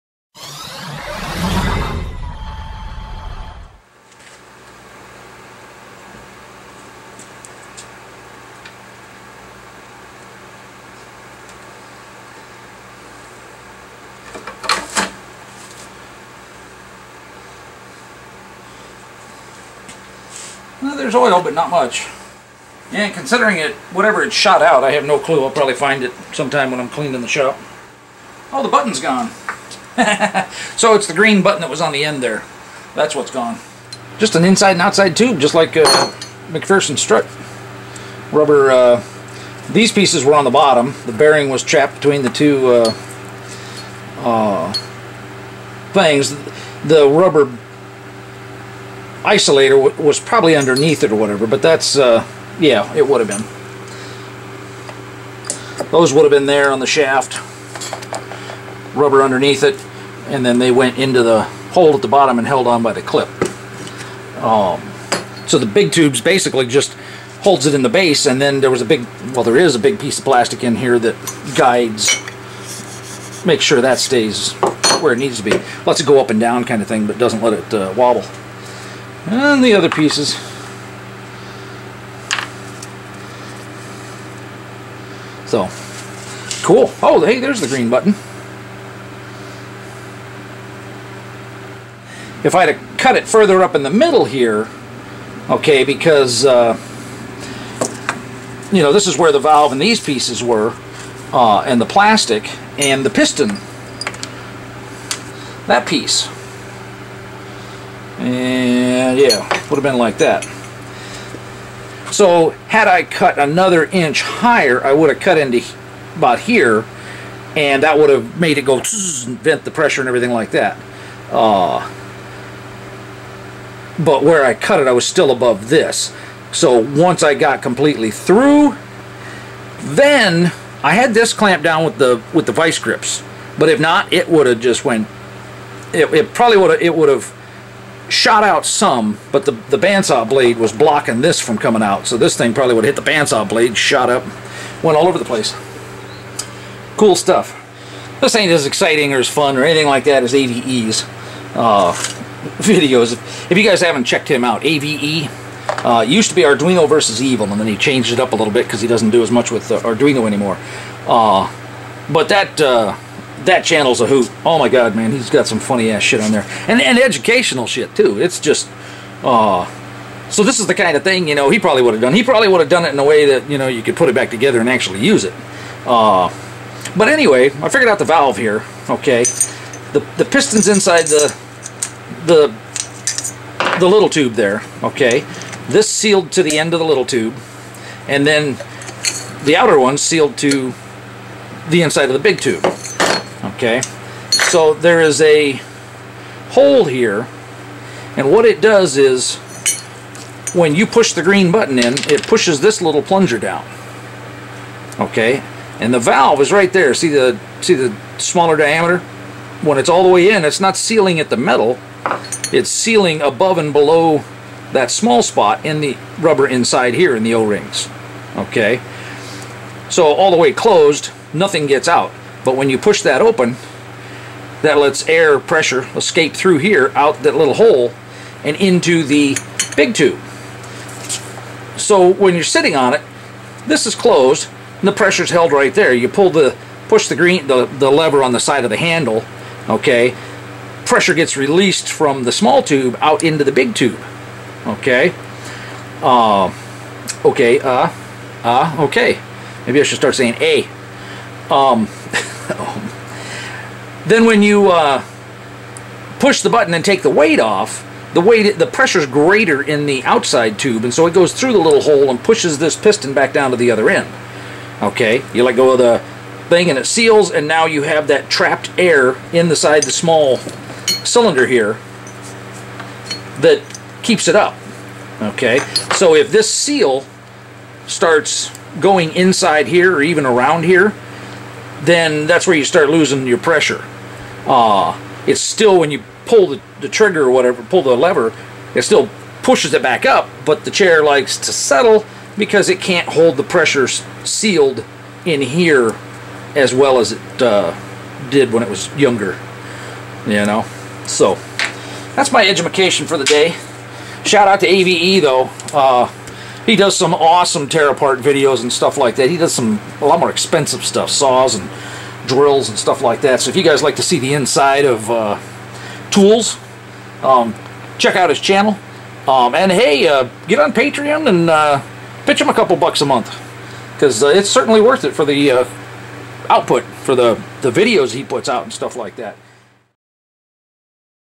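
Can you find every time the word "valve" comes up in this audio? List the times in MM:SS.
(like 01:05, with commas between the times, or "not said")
01:39, 02:58, 03:25.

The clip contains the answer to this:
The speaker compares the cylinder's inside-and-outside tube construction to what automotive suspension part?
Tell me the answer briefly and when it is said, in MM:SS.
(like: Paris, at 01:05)
MacPherson strut, at 00:36.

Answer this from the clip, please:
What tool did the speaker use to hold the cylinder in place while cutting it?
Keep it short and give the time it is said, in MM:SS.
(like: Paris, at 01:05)
Vice grips, at 02:12.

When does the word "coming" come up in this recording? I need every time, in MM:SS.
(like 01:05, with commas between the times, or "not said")
02:21.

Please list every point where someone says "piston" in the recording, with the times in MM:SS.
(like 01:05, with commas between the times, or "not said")
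01:43, 03:00, 04:22.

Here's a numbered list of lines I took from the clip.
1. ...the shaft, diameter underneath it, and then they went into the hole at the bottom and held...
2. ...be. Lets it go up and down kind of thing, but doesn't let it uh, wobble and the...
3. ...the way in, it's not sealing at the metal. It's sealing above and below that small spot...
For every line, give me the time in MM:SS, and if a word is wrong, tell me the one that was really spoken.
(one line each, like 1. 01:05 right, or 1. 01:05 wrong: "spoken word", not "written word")
1. 00:56 wrong: "rubber", not "diameter"
2. 01:15 right
3. 03:30 right.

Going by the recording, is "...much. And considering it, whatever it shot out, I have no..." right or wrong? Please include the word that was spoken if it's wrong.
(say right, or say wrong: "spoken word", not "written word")
right.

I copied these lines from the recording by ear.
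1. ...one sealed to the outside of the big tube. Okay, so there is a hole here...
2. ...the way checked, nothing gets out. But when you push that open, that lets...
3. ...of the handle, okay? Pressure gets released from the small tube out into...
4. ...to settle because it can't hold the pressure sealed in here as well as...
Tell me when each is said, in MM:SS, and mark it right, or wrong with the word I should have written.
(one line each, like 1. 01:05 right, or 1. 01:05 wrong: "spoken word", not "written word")
1. 03:09 wrong: "inside", not "outside"
2. 03:40 wrong: "closed", not "checked"
3. 03:58 right
4. 04:51 right.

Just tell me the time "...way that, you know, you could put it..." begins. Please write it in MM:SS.
02:53.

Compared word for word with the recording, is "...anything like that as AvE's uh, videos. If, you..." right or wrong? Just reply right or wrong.
right.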